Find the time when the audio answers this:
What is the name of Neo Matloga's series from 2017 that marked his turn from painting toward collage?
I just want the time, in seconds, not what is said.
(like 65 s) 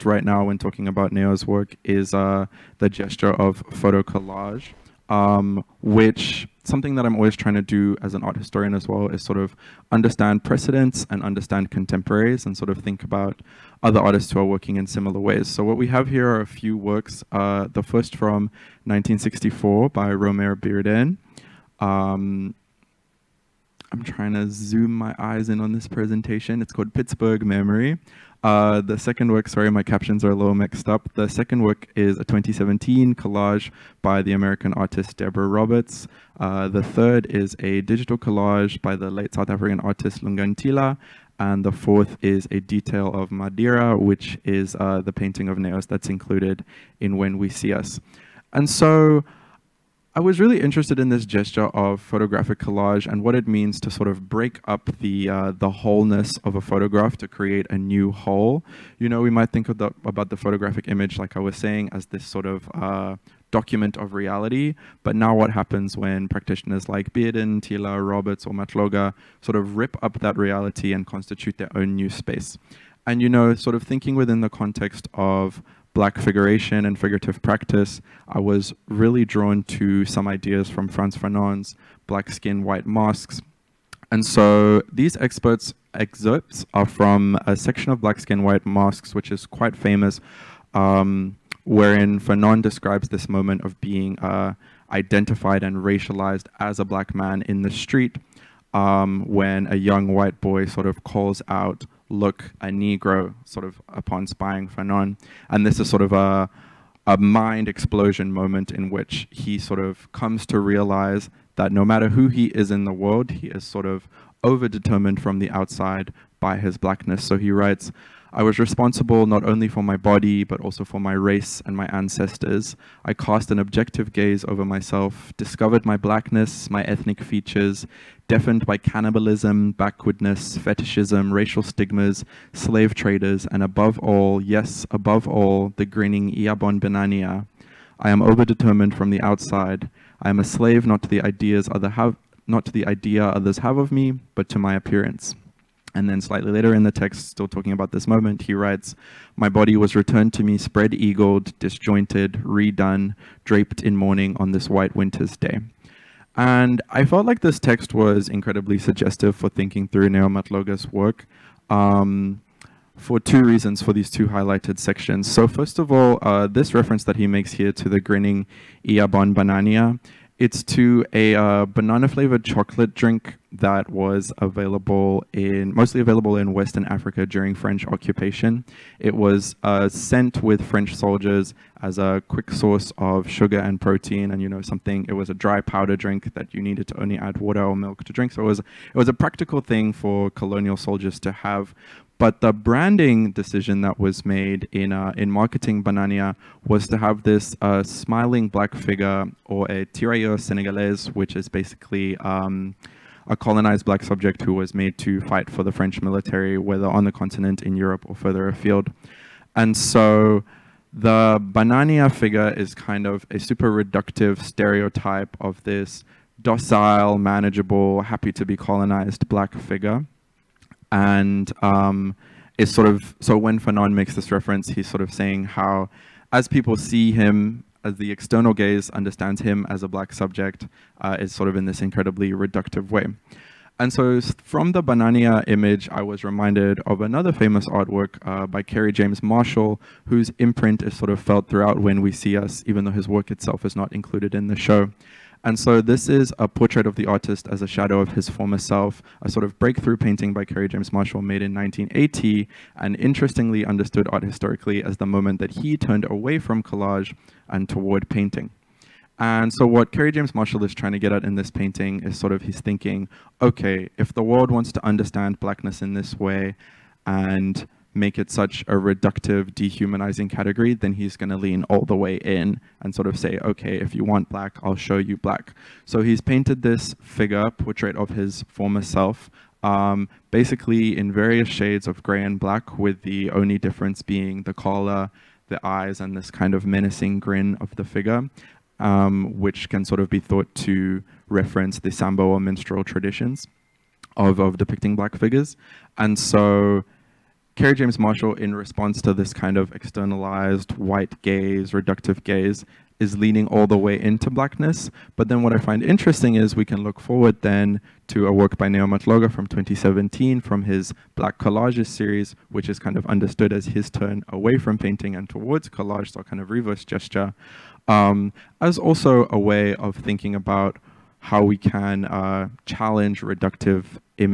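311 s.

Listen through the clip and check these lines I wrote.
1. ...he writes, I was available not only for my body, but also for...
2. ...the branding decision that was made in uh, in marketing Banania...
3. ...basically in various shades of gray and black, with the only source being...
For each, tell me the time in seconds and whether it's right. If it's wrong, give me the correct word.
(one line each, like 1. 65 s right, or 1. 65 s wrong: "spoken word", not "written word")
1. 117 s wrong: "responsible", not "available"
2. 192 s right
3. 280 s wrong: "difference", not "source".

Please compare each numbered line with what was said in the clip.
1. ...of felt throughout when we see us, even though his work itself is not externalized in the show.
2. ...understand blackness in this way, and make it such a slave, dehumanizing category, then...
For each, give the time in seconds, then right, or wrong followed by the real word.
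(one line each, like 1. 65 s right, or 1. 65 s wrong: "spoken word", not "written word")
1. 241 s wrong: "included", not "externalized"
2. 264 s wrong: "reductive", not "slave".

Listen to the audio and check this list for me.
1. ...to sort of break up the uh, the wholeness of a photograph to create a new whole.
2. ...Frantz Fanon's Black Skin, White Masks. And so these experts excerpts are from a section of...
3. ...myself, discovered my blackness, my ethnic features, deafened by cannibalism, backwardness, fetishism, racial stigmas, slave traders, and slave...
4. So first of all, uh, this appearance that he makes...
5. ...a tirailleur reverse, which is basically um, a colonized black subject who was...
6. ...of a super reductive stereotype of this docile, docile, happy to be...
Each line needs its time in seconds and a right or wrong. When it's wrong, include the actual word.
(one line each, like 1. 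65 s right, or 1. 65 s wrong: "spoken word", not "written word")
1. 53 s right
2. 80 s right
3. 124 s wrong: "above", not "slave"
4. 165 s wrong: "reference", not "appearance"
5. 199 s wrong: "senegalese", not "reverse"
6. 213 s wrong: "manageable", not "docile".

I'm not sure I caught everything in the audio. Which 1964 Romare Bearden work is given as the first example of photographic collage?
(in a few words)
Pittsburgh Memory.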